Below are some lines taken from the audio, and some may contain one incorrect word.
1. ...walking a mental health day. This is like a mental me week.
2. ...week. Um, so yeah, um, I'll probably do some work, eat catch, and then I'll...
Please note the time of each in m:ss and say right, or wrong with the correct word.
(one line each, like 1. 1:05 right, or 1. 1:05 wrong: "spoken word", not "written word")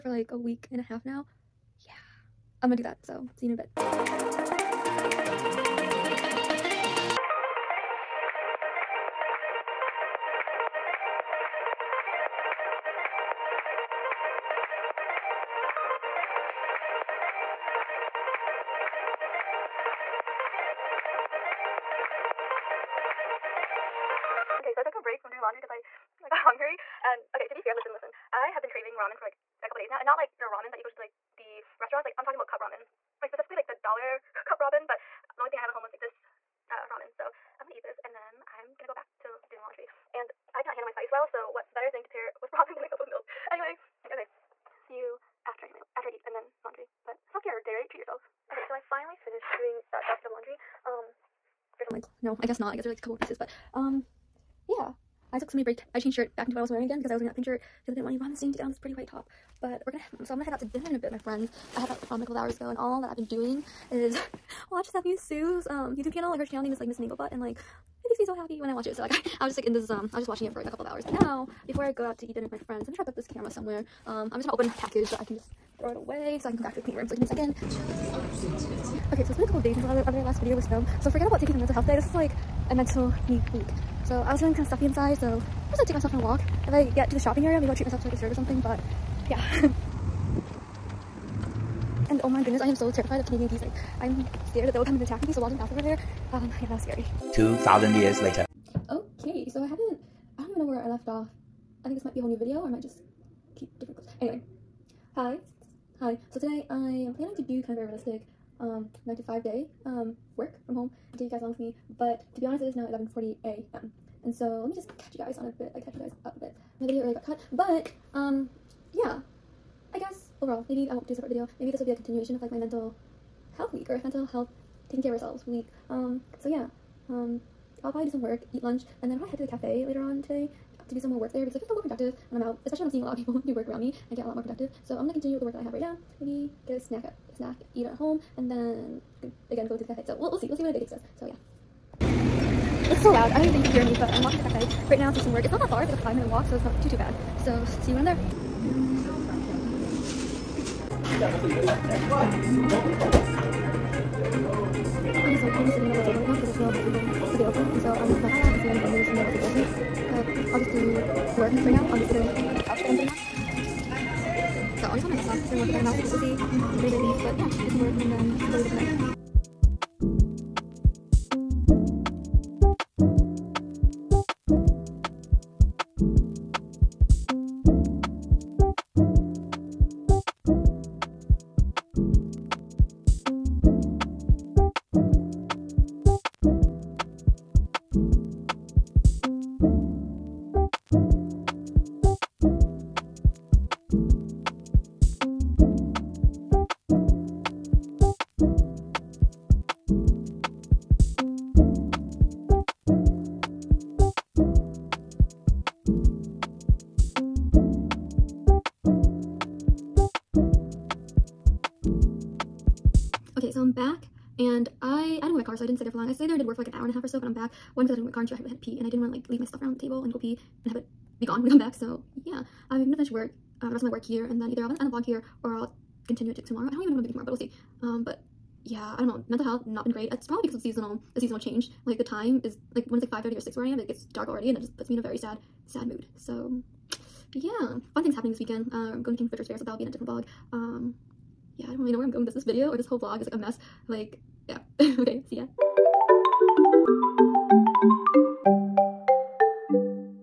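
1. 1:21 wrong: "taking", not "walking"
2. 2:05 wrong: "lunch", not "catch".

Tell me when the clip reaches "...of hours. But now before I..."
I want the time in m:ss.
1:10.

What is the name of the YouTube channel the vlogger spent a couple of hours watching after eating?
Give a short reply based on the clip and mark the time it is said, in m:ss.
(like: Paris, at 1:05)
Miss Butt, at 1:06.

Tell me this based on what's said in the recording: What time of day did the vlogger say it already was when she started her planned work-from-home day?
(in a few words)
11:40 a.m.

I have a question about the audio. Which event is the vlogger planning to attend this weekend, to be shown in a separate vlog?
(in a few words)
King Richard's Fair.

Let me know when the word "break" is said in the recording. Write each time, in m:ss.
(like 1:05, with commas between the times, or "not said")
0:25, 0:55.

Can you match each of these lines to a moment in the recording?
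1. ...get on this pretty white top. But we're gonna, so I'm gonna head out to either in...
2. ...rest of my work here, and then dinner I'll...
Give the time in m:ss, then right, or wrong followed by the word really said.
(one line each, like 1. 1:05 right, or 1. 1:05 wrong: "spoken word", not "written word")
1. 0:58 wrong: "dinner", not "either"
2. 3:43 wrong: "either", not "dinner".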